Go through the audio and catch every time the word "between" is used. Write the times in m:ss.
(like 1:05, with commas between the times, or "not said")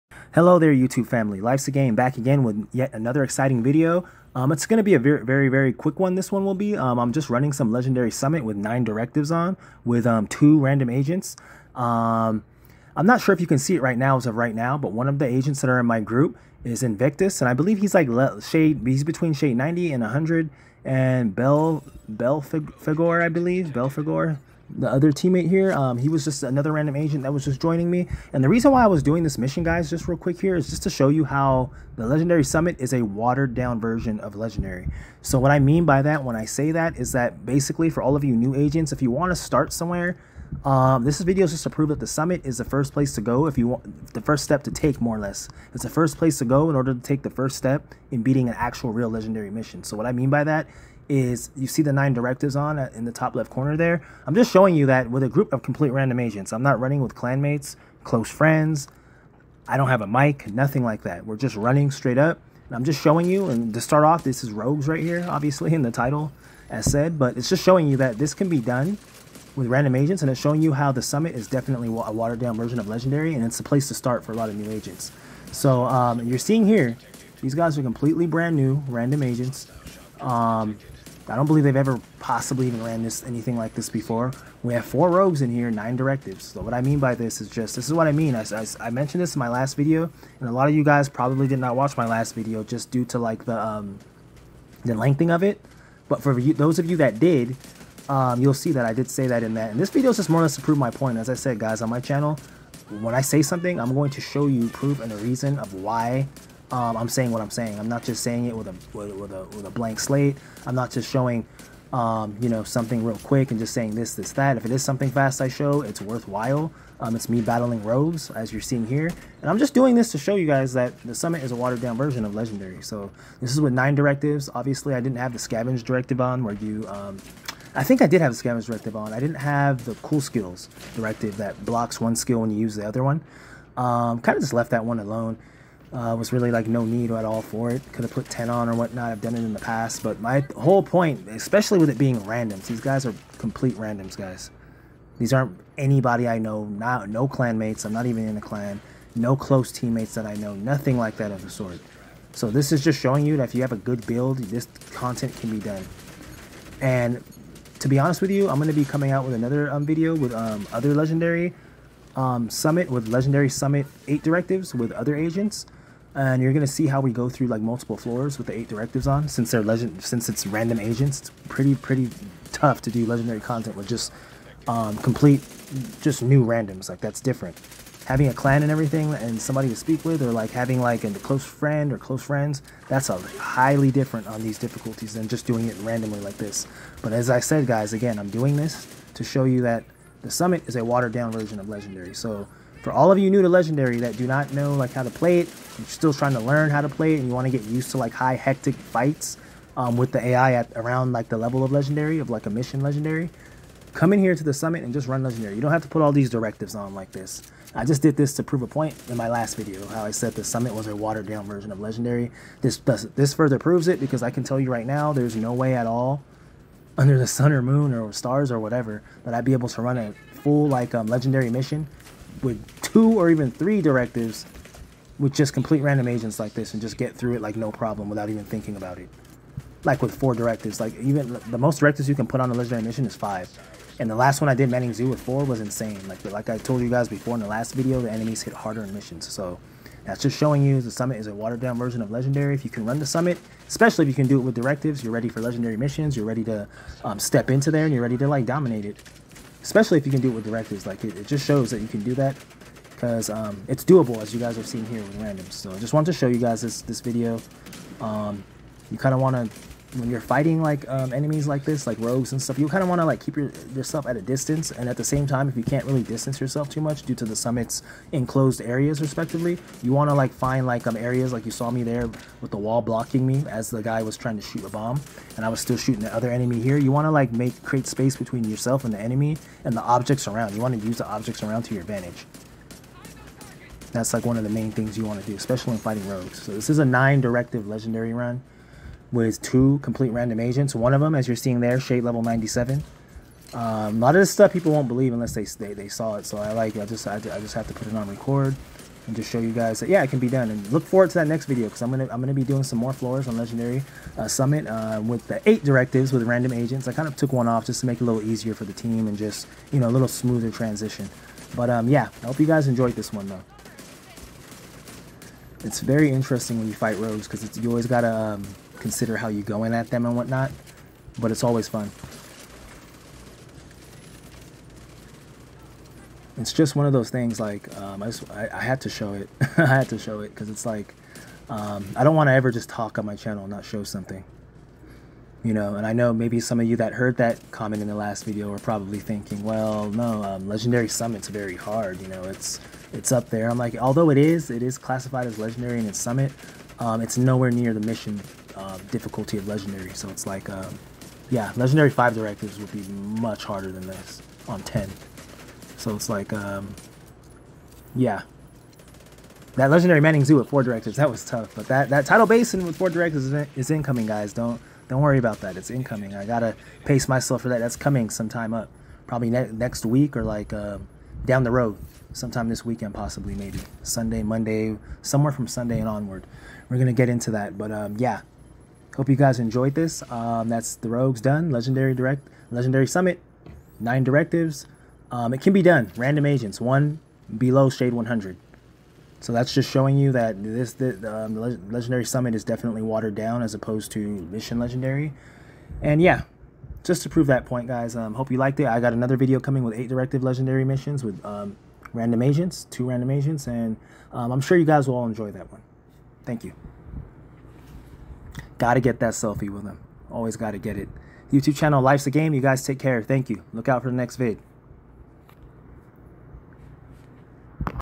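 0:19, 4:38.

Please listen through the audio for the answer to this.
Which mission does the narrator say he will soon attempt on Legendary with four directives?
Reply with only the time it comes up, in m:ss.
6:02.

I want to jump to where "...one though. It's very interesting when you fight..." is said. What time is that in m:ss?
5:13.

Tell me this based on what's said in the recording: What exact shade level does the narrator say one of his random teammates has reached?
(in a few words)
97.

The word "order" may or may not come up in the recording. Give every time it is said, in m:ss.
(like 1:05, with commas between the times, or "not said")
0:46.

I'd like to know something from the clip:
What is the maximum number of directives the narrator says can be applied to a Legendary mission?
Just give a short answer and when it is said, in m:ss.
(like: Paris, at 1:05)
5, at 3:53.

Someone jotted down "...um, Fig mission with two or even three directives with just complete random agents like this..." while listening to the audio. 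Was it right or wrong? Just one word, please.
wrong.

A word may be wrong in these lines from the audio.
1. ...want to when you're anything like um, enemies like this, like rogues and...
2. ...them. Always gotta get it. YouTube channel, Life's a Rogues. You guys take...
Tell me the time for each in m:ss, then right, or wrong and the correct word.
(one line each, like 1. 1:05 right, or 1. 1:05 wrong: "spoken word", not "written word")
1. 4:19 wrong: "fighting", not "anything"
2. 6:49 wrong: "Game", not "Rogues".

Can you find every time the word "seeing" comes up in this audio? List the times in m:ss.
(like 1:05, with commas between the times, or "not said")
1:16, 1:58, 4:51.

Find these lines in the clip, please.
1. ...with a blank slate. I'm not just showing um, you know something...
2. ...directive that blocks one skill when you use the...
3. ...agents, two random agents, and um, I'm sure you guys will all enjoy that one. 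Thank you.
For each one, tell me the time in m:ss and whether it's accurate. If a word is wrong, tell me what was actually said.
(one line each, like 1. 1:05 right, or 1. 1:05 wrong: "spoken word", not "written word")
1. 1:49 right
2. 2:10 right
3. 6:42 right.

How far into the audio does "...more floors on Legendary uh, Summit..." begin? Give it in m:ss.
5:02.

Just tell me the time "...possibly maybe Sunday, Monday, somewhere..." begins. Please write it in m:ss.
6:12.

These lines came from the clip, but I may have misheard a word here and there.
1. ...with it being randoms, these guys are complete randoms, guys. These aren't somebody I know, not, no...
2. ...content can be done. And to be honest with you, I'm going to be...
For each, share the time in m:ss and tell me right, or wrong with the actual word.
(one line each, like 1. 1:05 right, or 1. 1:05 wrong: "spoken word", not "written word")
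1. 2:21 wrong: "anybody", not "somebody"
2. 2:34 right.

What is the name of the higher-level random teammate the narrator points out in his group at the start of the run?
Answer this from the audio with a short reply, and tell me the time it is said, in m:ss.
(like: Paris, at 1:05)
Invictus, at 0:16.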